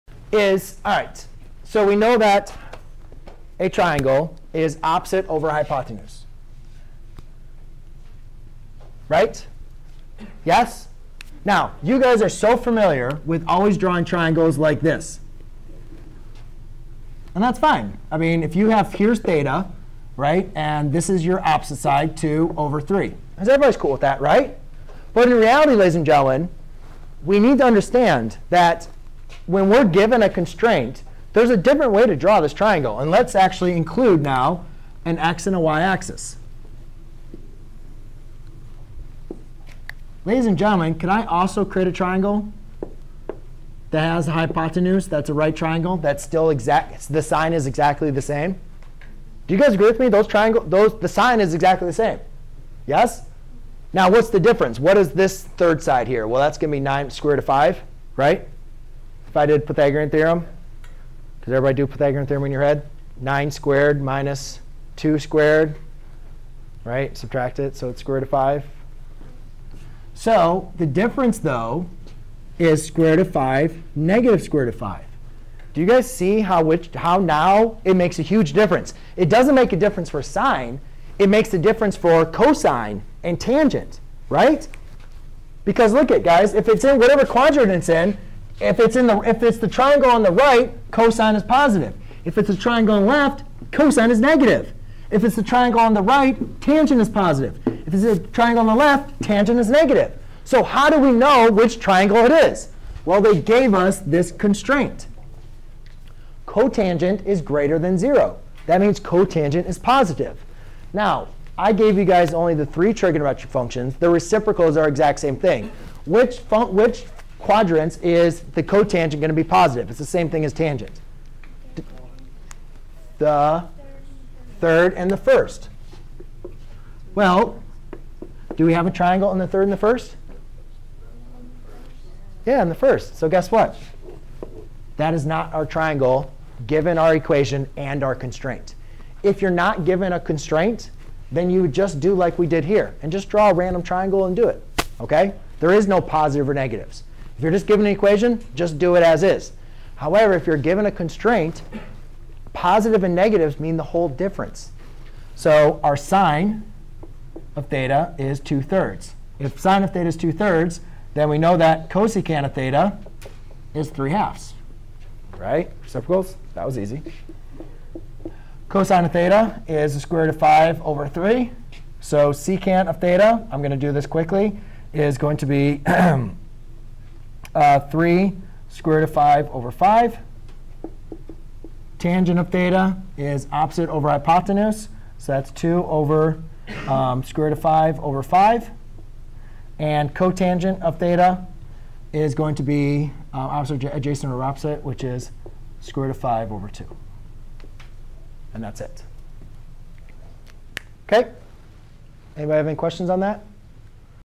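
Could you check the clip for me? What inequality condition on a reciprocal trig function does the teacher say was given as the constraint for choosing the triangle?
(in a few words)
Cotangent is greater than 0.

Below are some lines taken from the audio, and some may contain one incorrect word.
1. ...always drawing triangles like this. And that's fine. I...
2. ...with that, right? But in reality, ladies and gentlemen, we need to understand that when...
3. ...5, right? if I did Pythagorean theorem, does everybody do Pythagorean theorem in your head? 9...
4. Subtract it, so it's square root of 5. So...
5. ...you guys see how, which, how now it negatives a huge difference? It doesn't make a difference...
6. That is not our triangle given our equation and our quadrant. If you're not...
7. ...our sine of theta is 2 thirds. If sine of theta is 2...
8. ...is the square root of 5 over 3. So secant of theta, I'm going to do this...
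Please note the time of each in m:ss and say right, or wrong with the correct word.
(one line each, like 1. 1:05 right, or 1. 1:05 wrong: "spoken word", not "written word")
1. 0:13 right
2. 0:23 right
3. 0:57 right
4. 1:07 right
5. 1:15 wrong: "makes", not "negatives"
6. 2:14 wrong: "constraint", not "quadrant"
7. 2:35 right
8. 2:49 right.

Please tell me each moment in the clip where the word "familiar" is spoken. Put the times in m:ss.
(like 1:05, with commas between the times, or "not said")
0:12.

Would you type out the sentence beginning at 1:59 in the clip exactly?
It's the same thing as tangent.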